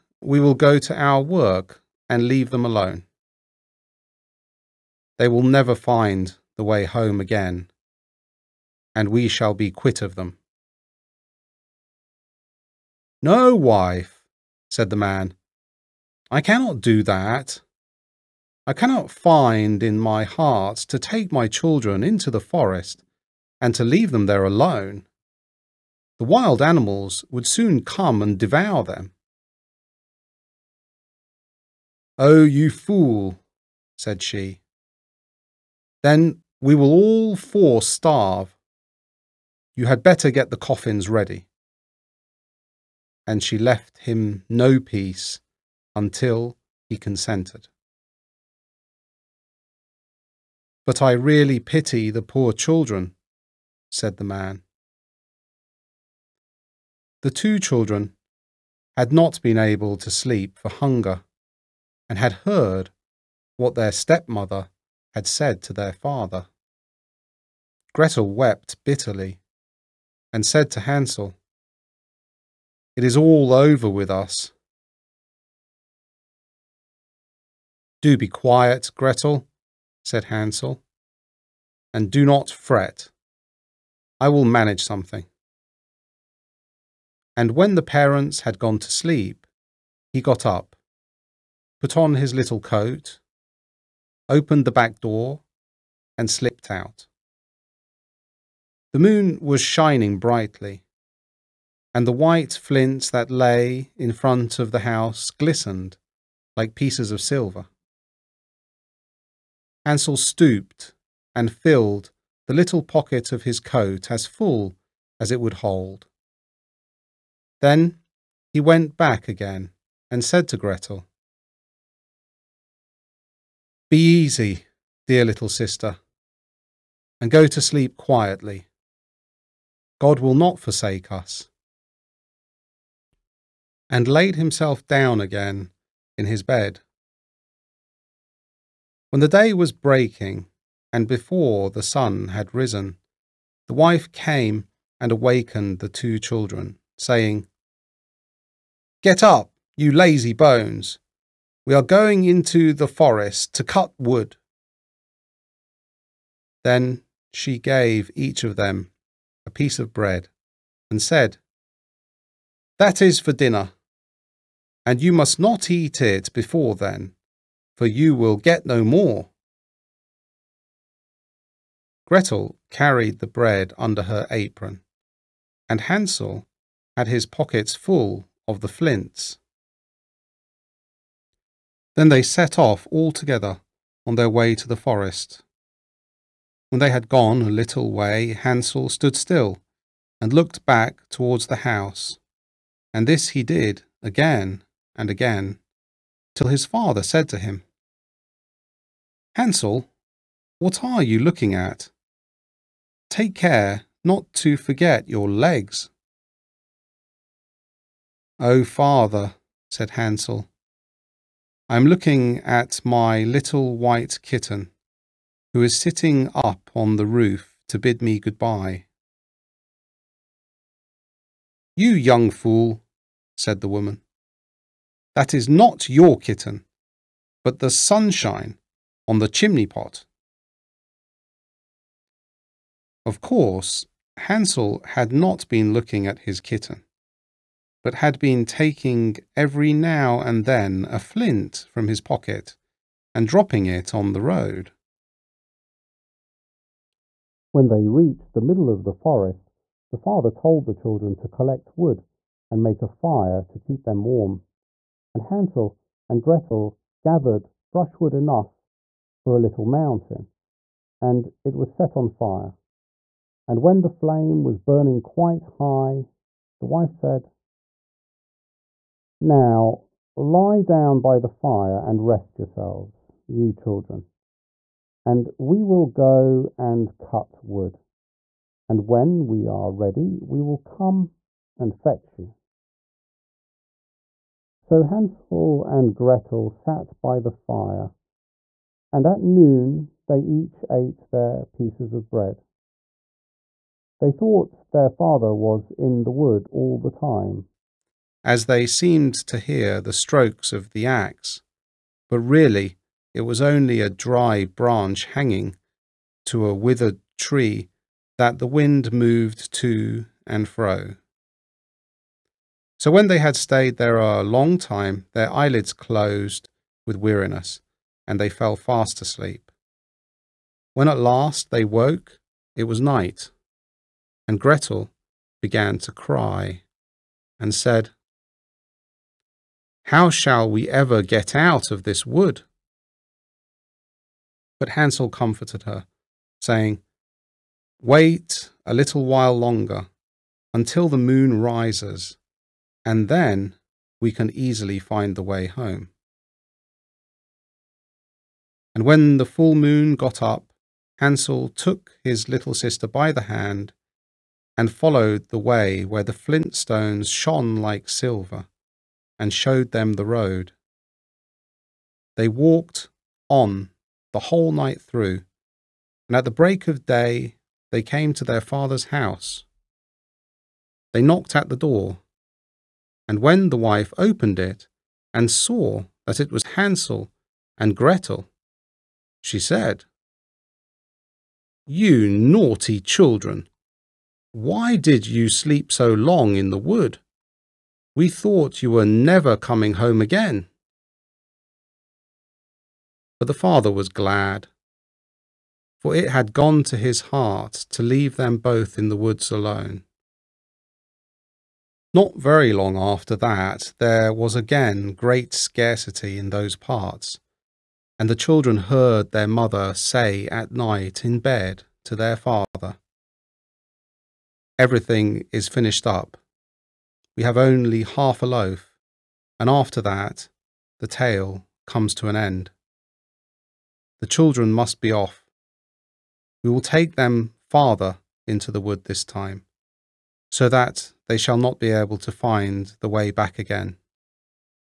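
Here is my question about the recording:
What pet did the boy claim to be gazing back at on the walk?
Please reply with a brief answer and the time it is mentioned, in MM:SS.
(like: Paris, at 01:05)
White kitten, at 03:33.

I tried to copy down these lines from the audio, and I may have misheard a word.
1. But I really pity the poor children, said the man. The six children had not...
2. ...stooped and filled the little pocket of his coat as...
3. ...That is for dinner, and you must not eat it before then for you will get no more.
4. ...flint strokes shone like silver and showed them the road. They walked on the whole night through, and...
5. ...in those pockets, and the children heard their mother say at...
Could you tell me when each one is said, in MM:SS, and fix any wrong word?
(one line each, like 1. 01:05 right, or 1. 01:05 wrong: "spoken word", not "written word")
1. 00:50 wrong: "two", not "six"
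2. 01:50 right
3. 02:42 right
4. 05:56 wrong: "stones", not "strokes"
5. 06:46 wrong: "parts", not "pockets".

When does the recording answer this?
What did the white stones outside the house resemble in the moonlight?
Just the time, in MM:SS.
01:46.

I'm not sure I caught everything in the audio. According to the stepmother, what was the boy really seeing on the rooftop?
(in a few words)
Sunshine on the chimney pot.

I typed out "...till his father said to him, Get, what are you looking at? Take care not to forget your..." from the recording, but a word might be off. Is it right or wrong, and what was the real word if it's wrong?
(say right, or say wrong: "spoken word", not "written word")
wrong: "Hansel", not "Get".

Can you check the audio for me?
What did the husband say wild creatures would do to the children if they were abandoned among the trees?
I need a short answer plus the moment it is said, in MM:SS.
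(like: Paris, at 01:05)
Devour them, at 00:28.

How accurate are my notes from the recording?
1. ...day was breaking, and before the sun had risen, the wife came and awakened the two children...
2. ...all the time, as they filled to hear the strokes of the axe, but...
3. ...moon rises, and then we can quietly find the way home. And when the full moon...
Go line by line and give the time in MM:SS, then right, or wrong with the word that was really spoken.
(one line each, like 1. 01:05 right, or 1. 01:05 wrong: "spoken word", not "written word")
1. 02:19 right
2. 04:56 wrong: "seemed", not "filled"
3. 05:40 wrong: "easily", not "quietly".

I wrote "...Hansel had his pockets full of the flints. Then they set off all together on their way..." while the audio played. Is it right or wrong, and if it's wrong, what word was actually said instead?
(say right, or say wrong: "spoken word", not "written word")
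right.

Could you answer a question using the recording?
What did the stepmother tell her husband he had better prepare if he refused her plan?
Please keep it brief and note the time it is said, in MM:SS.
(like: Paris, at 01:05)
The coffins, at 00:40.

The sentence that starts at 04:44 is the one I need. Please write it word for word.
So Hansel and Gretel sat by the fire and at noon they each ate their pieces of bread.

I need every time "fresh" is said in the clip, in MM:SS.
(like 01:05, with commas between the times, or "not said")
not said.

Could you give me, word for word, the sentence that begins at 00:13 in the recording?
No, wife, said the man, I cannot do that.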